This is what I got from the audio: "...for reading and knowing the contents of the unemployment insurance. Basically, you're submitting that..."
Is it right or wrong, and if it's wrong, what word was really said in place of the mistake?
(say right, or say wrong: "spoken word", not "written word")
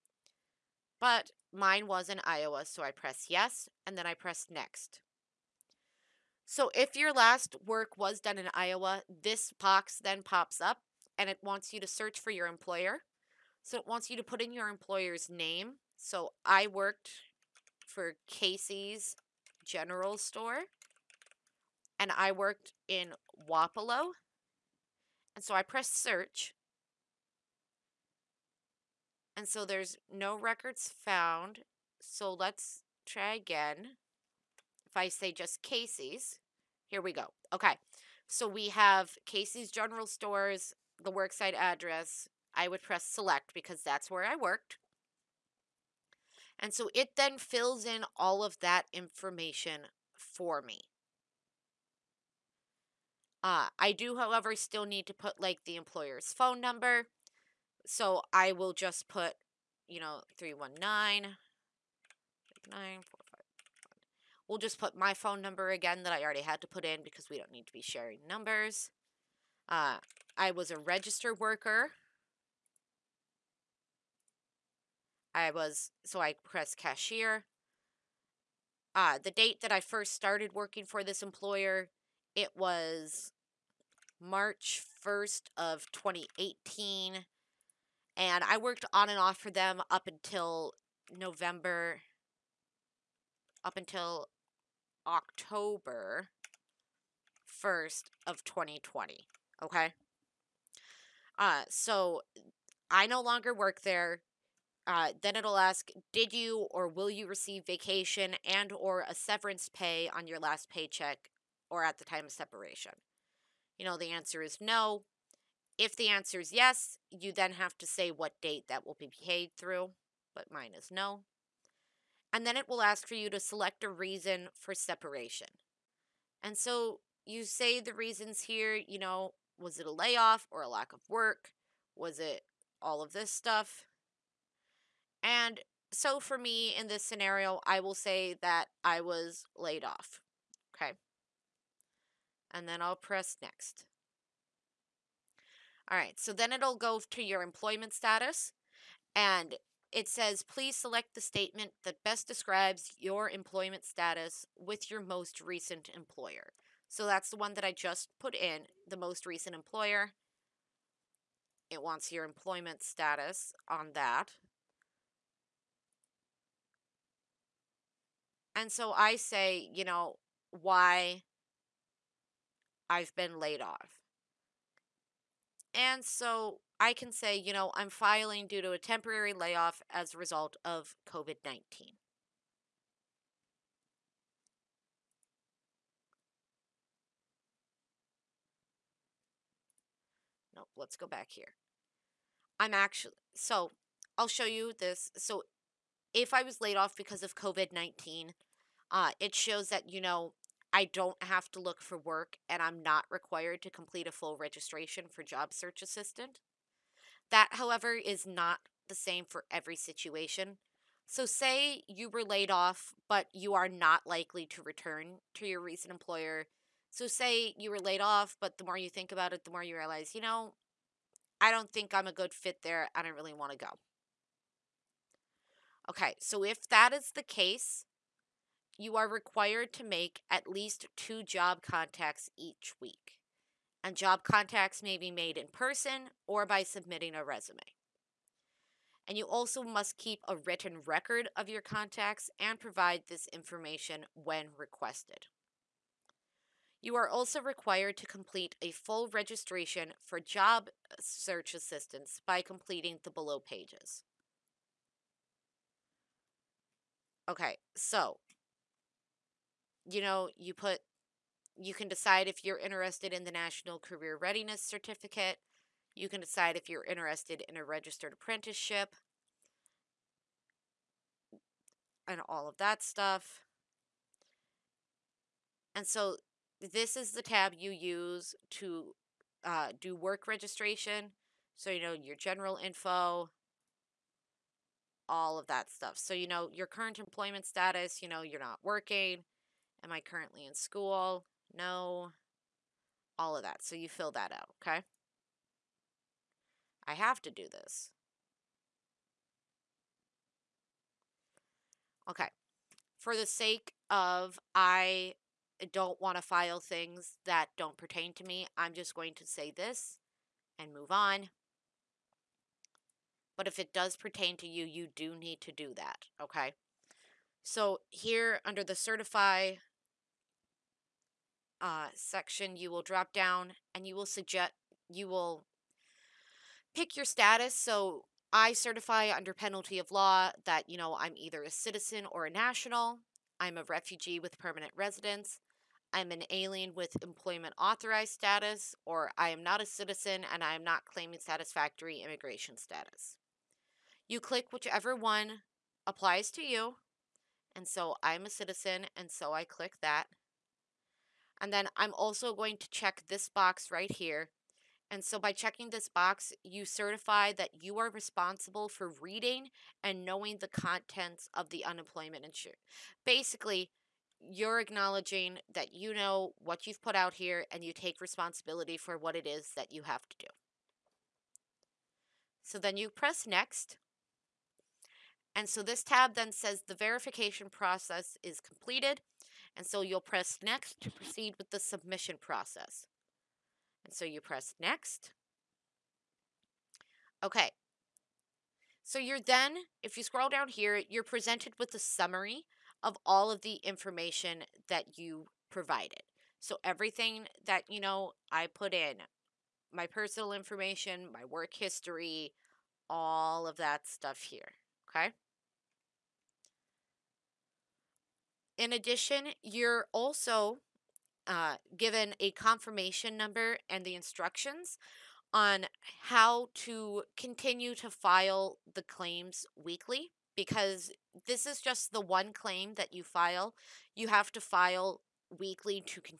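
wrong: "acknowledging", not "submitting".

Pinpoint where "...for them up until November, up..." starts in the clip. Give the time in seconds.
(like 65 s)
89 s.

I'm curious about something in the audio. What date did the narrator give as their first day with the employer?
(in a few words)
March 1, 2018.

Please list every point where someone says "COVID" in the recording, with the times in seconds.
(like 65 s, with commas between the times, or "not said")
181 s, 197 s.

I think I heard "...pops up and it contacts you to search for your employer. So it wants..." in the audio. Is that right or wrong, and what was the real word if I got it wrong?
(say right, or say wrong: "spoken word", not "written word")
wrong: "wants", not "contacts".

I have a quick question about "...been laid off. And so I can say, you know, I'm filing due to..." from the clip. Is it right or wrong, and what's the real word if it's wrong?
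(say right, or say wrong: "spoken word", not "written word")
right.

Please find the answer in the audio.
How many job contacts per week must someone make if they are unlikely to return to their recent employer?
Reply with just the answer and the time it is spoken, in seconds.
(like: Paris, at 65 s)
2, at 230 s.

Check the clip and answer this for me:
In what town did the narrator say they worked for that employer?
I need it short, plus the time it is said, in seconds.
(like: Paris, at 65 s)
Wapello, at 23 s.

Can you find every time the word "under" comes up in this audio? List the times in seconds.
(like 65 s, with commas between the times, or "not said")
318 s, 329 s.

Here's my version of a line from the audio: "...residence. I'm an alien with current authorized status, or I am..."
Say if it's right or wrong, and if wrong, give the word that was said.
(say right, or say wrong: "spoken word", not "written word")
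wrong: "employment", not "current".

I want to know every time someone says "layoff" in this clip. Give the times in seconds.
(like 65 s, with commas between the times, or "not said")
129 s, 179 s.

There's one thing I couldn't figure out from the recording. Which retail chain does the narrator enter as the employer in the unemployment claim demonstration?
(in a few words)
Casey's General Store.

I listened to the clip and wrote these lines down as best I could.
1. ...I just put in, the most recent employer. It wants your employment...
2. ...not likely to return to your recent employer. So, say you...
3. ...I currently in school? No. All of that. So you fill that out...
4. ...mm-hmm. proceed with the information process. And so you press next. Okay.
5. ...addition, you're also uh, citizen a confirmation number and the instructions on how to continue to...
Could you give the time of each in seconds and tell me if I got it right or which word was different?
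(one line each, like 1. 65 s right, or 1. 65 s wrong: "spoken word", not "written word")
1. 157 s right
2. 213 s right
3. 289 s right
4. 380 s wrong: "submission", not "information"
5. 408 s wrong: "given", not "citizen".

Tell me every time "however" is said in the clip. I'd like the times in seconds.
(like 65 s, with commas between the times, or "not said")
54 s, 207 s.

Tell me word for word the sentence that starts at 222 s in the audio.
I don't really want to go.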